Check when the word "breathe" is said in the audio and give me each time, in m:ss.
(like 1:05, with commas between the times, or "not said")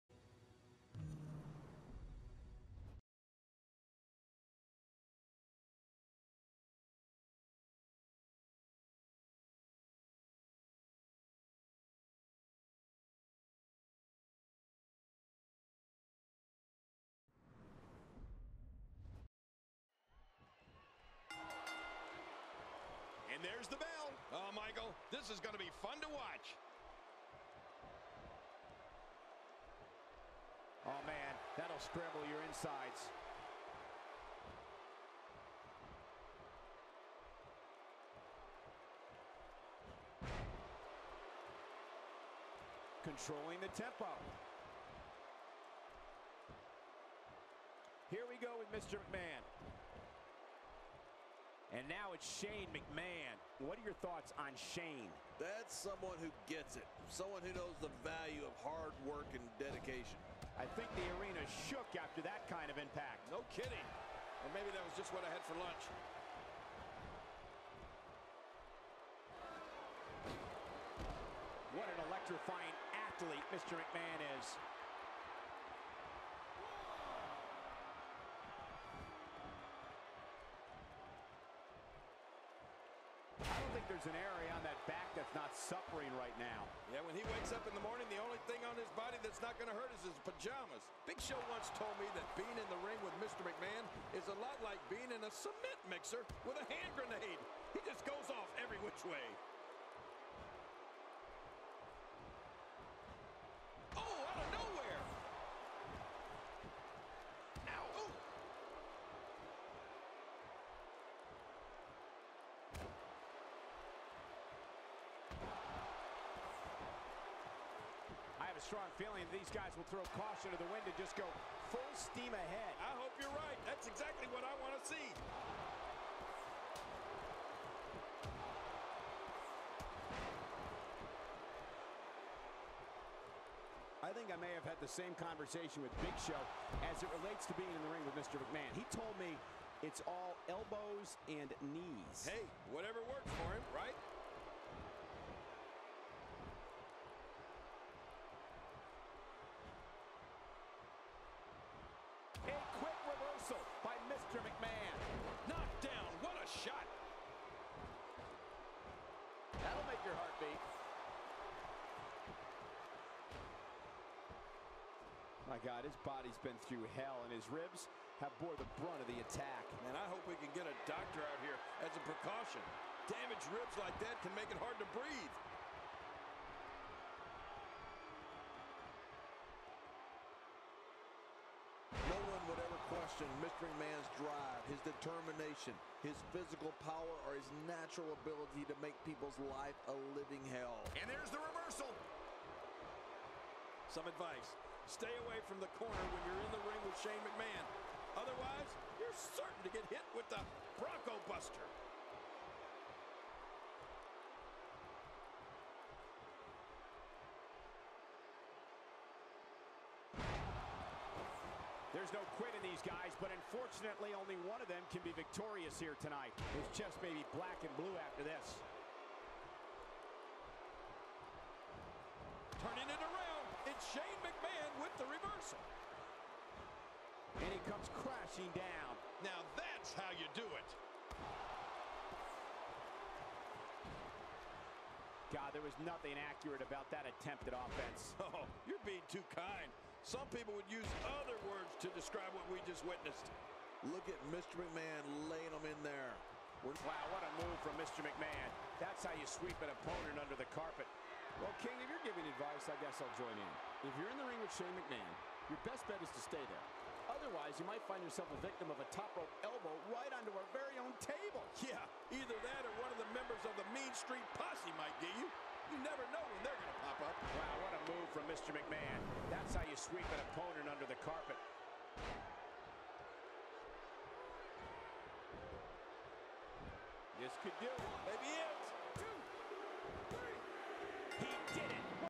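2:54.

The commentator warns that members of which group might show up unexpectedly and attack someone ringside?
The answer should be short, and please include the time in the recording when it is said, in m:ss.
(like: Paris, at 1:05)
Mean Street Posse, at 4:23.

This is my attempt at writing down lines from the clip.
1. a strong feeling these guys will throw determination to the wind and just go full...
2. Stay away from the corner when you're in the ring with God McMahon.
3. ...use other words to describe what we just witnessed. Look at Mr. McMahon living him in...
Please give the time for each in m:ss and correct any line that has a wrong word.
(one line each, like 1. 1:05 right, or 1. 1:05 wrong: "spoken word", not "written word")
1. 1:58 wrong: "caution", not "determination"
2. 3:14 wrong: "Shane", not "God"
3. 4:00 wrong: "laying", not "living".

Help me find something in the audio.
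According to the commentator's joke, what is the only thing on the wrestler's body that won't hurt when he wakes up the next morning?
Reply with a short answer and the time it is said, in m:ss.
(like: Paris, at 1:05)
His pajamas, at 1:30.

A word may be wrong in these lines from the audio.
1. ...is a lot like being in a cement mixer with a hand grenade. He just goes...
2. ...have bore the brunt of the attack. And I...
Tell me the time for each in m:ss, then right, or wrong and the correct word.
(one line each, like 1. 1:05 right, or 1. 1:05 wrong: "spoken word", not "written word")
1. 1:34 right
2. 2:48 right.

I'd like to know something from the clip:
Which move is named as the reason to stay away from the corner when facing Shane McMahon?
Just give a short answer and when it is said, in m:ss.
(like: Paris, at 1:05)
Bronco Buster, at 3:20.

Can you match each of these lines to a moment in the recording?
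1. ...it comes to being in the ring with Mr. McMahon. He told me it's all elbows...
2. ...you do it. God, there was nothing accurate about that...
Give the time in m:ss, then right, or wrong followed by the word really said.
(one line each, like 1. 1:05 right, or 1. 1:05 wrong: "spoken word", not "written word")
1. 2:17 wrong: "relates", not "comes"
2. 3:50 right.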